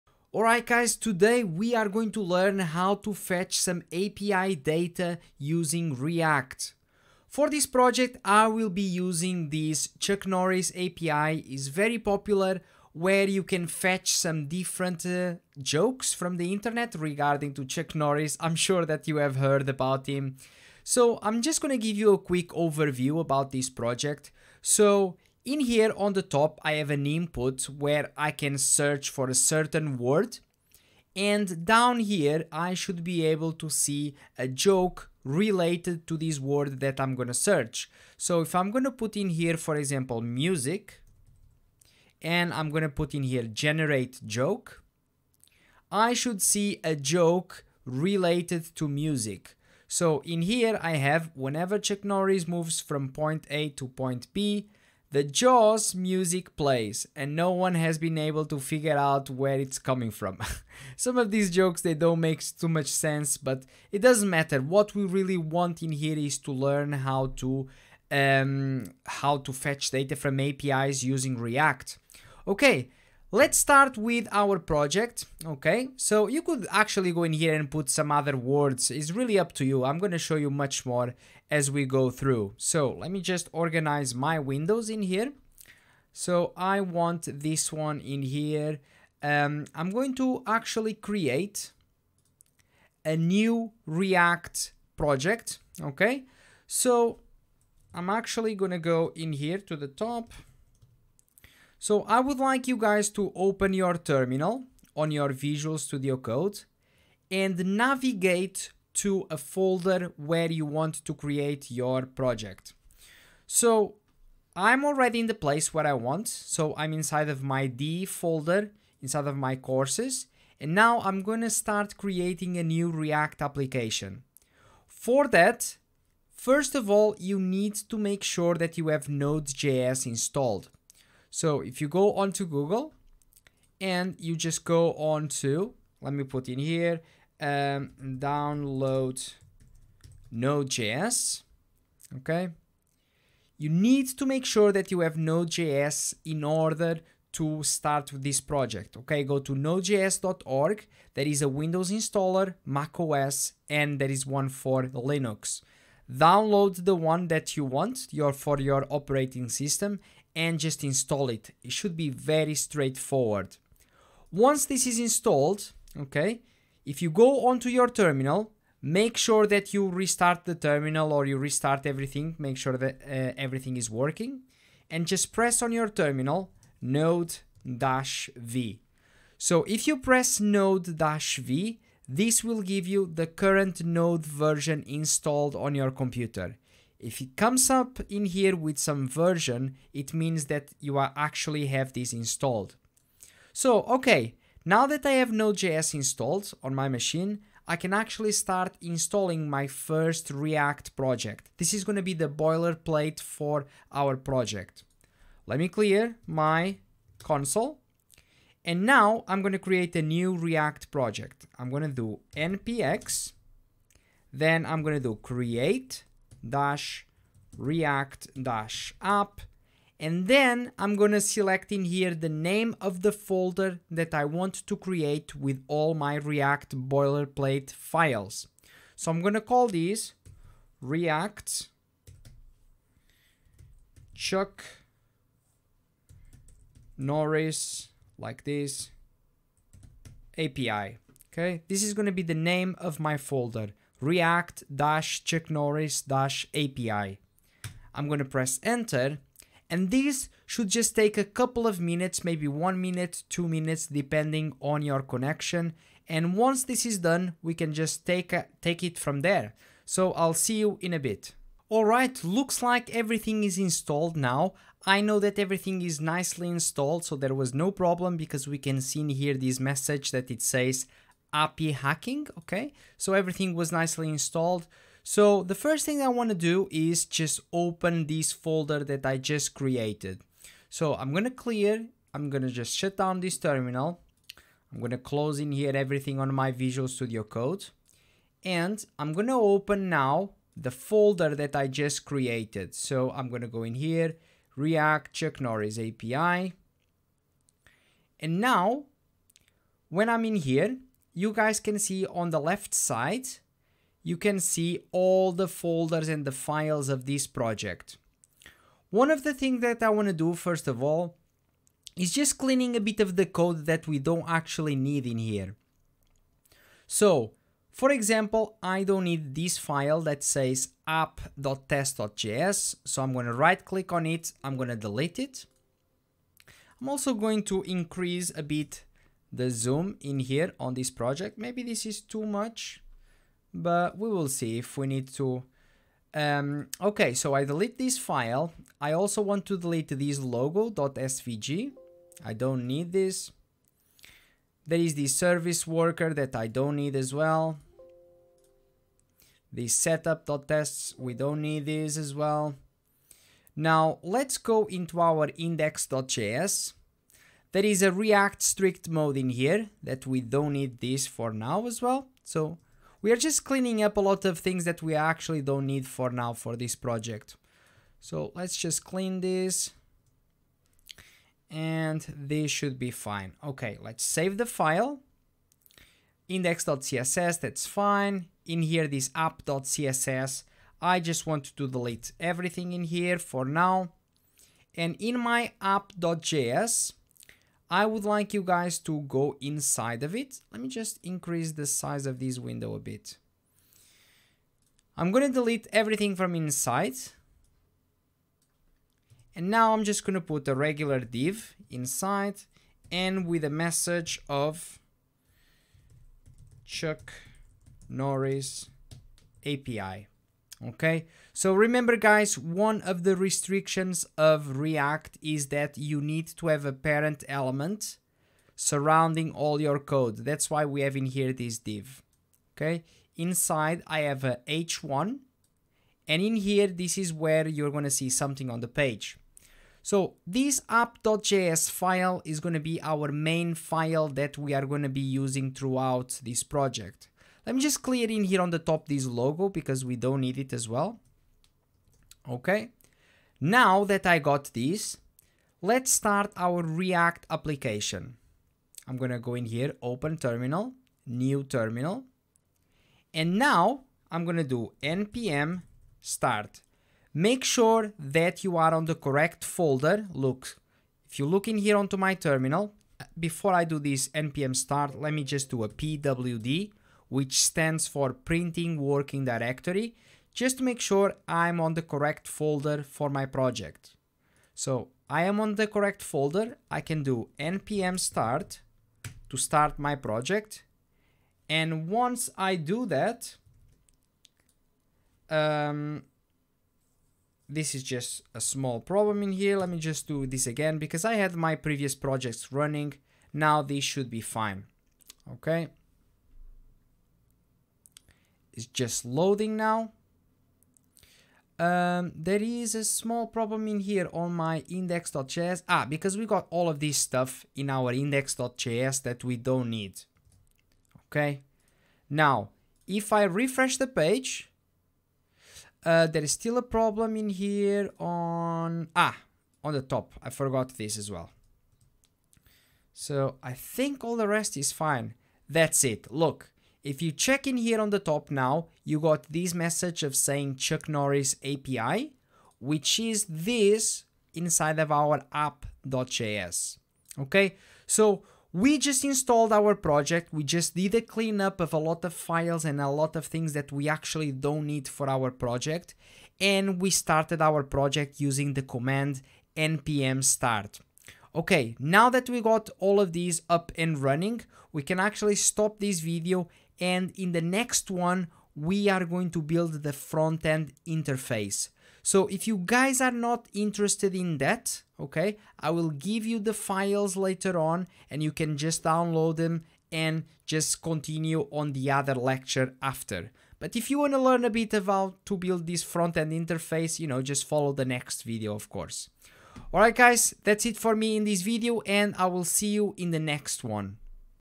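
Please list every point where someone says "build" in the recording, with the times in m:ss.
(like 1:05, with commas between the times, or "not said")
9:19, 9:35.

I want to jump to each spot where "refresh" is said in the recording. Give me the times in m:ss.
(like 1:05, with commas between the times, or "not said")
8:33.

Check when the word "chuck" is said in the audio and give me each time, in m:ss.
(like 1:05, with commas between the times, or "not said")
0:09, 0:17, 0:51, 3:54, 4:05, 4:55, 6:46, 8:50.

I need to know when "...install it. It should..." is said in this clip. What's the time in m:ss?
2:40.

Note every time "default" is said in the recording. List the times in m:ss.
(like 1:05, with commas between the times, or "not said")
not said.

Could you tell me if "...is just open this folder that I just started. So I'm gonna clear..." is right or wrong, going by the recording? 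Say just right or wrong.
wrong.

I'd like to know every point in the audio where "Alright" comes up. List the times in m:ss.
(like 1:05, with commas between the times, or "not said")
0:00, 4:21, 9:39.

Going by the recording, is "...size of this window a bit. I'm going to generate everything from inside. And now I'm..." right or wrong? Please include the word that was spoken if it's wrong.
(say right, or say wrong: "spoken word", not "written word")
wrong: "delete", not "generate".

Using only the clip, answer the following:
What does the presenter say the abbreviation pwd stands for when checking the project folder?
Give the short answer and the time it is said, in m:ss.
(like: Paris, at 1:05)
Printing Working Directory, at 7:48.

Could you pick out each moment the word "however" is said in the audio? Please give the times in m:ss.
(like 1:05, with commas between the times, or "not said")
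not said.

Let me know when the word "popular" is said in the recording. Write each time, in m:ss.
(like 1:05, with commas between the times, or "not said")
0:11.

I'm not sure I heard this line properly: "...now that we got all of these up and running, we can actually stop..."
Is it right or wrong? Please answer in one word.
right.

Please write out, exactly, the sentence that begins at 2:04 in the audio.
For that, first of all, you need to make sure that you have Node.js installed.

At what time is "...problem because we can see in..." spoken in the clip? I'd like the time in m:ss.
4:27.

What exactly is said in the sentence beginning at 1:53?
So I'm already in the place where I want.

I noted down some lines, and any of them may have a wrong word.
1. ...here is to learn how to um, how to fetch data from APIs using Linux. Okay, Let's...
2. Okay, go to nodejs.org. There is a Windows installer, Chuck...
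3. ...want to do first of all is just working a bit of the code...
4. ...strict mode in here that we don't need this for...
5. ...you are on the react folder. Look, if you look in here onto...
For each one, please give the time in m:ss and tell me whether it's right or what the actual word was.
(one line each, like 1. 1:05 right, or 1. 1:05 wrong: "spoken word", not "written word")
1. 1:05 wrong: "React", not "Linux"
2. 2:28 wrong: "Mac", not "Chuck"
3. 5:09 wrong: "cleaning", not "working"
4. 5:58 right
5. 7:38 wrong: "correct", not "react".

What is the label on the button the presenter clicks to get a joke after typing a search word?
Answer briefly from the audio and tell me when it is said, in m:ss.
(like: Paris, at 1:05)
generate joke, at 0:43.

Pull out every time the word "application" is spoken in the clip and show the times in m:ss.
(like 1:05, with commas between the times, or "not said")
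2:03, 7:27.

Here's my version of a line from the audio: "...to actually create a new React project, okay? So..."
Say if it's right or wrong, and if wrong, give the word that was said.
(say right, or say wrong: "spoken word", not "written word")
right.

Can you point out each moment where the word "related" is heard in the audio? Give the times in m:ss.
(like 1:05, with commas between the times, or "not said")
0:35, 0:47.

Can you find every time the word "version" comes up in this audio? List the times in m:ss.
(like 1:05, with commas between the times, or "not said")
3:04, 3:09.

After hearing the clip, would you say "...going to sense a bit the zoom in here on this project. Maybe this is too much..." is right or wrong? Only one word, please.
wrong.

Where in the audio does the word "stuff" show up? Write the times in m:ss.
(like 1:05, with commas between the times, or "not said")
8:26.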